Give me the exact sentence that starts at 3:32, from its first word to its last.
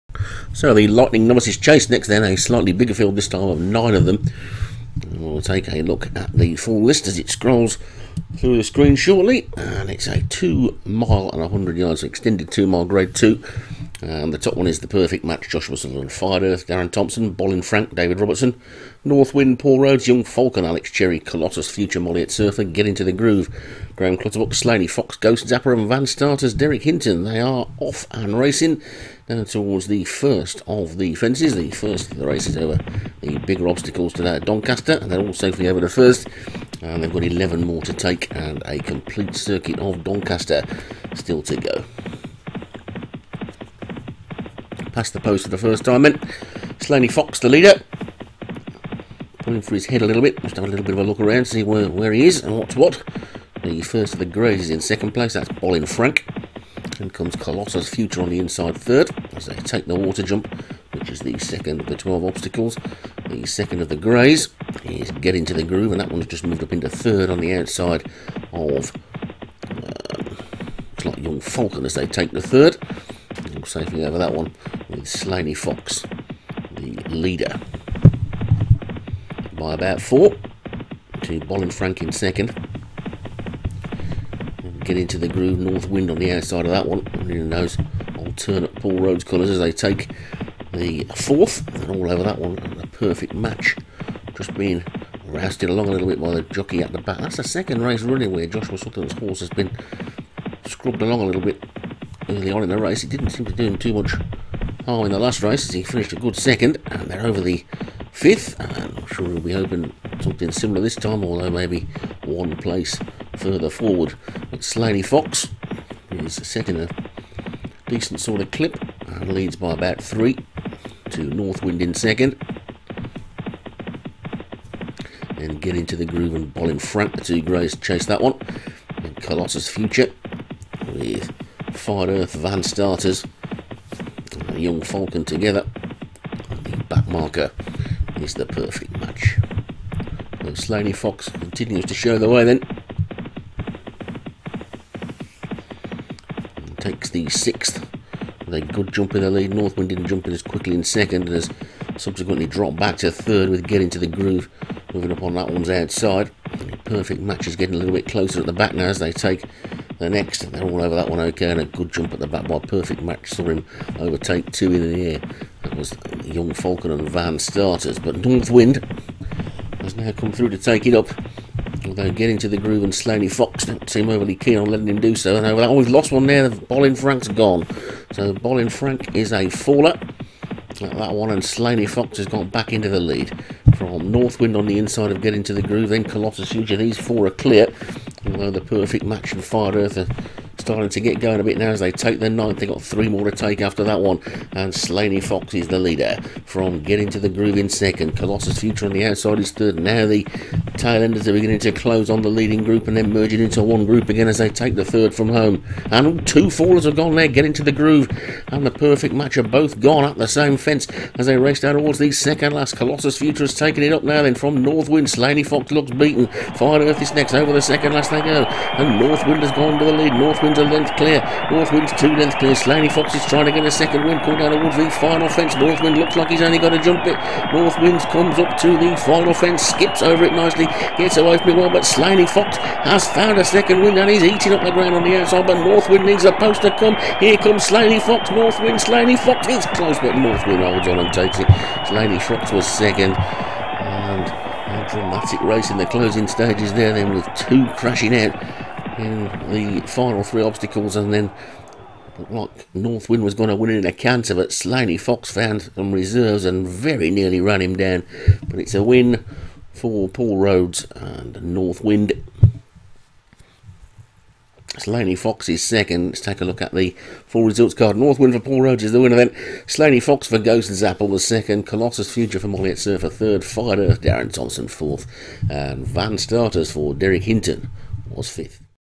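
Colossus Future has taken it up now then from Northwind.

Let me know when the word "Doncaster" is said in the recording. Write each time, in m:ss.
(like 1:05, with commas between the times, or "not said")
0:34, 0:40.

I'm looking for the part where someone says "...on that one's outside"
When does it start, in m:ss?
2:35.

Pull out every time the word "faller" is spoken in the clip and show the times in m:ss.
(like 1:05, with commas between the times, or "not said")
2:59, 3:26.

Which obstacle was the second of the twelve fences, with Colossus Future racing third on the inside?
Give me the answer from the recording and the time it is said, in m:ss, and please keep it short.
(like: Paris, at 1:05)
water jump, at 0:59.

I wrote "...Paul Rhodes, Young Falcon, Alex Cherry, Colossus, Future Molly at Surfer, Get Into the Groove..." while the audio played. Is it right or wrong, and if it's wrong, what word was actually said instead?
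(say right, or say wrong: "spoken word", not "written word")
right.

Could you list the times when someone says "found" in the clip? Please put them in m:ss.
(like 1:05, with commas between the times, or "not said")
3:53, 4:15.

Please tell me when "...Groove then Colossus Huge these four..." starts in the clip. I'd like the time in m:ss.
3:05.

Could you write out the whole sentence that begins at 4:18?
But it's a win for Paul Rhodes and North Wind.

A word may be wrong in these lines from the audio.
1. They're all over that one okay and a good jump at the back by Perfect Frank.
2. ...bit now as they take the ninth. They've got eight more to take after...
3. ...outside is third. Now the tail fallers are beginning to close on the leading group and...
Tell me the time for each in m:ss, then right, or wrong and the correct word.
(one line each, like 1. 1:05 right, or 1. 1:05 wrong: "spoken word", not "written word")
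1. 2:40 wrong: "Match", not "Frank"
2. 3:11 wrong: "three", not "eight"
3. 3:19 wrong: "enders", not "fallers".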